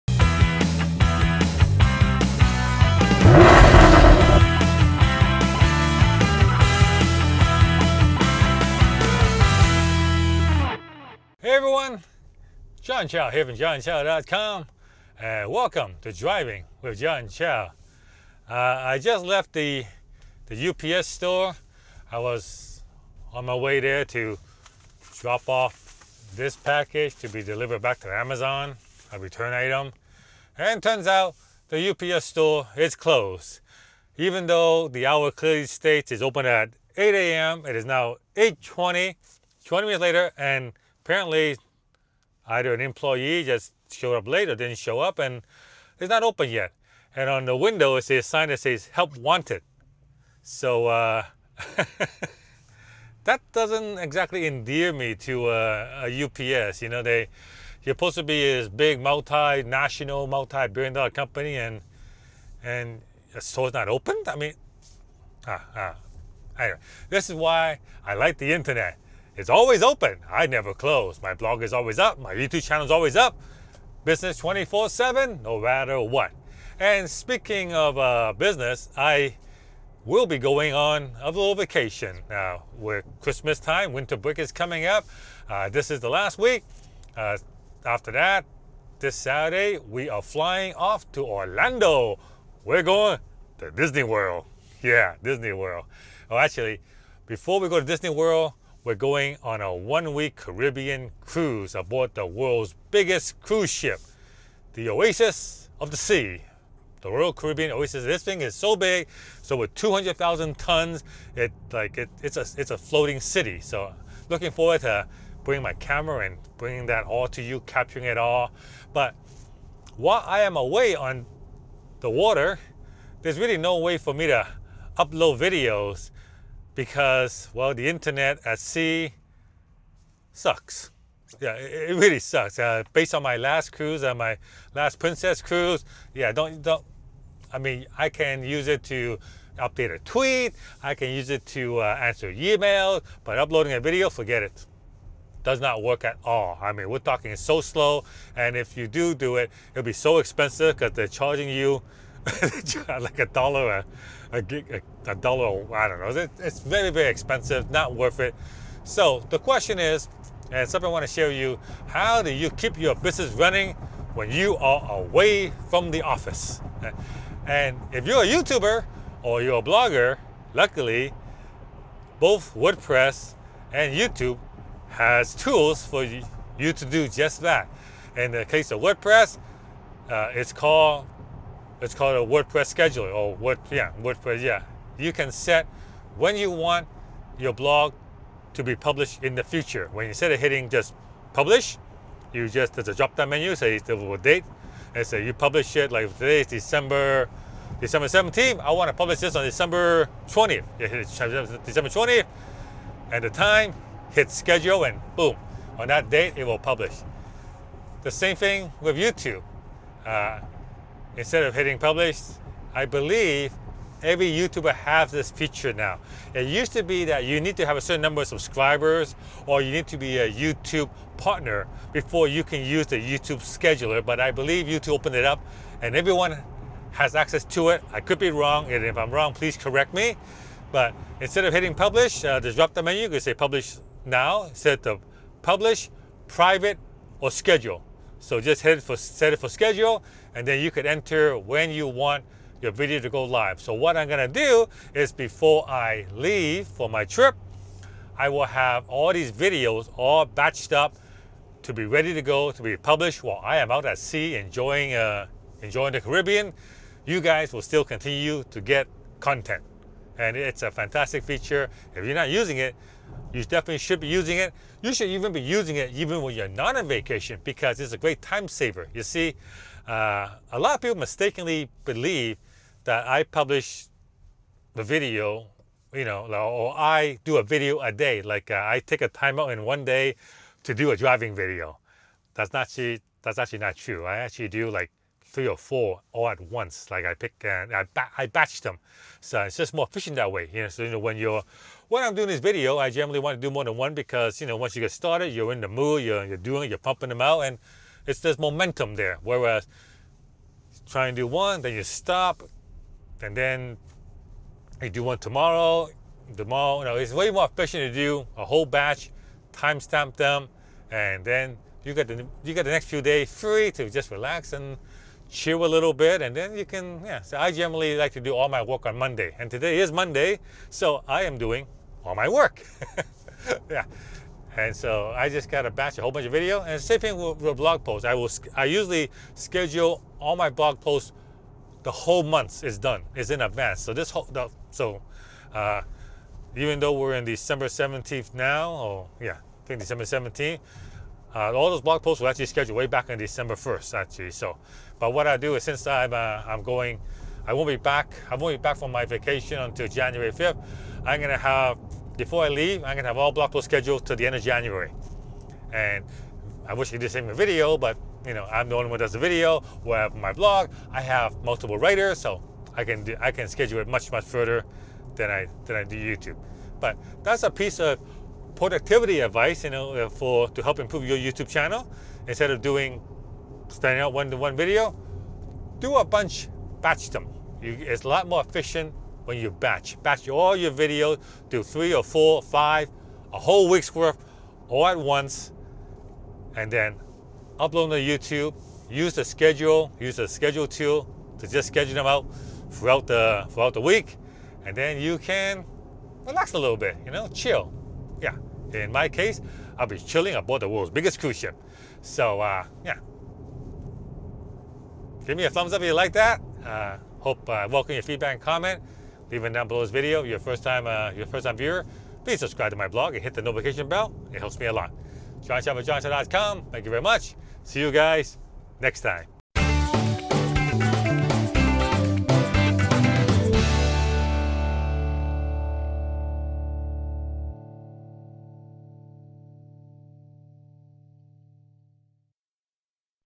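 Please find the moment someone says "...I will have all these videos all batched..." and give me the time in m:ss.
4:08.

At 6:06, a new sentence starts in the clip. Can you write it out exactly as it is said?
But that's a piece of productivity advice, you know, uh, for to help improve your YouTube channel.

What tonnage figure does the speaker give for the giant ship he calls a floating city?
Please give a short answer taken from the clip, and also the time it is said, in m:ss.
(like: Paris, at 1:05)
200,000 tons, at 1:49.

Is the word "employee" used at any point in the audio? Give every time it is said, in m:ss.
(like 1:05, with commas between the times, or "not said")
0:42.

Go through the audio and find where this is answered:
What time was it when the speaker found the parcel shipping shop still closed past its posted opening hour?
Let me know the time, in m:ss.
0:38.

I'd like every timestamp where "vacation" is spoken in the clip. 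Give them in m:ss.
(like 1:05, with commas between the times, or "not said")
1:21, 4:26, 5:49.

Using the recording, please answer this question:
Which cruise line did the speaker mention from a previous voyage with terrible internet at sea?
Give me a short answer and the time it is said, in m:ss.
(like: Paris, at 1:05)
Princess, at 2:14.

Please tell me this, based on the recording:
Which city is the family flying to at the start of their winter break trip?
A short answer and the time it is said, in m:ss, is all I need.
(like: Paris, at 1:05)
Orlando, at 1:31.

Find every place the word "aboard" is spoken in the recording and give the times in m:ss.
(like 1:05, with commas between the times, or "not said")
1:41, 6:40.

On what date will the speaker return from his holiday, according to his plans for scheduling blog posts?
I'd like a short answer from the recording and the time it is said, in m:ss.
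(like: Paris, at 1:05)
January 5th, at 5:49.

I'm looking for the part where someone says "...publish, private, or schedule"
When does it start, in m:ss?
3:55.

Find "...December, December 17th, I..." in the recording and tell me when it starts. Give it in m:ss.
3:16.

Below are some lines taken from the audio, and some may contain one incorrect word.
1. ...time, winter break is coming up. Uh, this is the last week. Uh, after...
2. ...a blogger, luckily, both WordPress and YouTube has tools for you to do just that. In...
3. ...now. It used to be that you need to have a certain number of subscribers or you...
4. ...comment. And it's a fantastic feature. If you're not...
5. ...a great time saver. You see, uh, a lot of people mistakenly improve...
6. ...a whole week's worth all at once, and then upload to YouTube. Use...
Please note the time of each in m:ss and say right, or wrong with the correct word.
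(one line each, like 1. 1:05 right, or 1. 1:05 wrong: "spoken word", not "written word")
1. 1:23 right
2. 2:49 right
3. 3:35 right
4. 4:19 wrong: "content", not "comment"
5. 4:27 wrong: "believe", not "improve"
6. 6:23 right.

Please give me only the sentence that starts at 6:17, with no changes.
You, it's a lot more efficient when you batch.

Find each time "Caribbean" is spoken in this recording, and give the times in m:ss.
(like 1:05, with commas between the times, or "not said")
1:40, 1:47, 4:16.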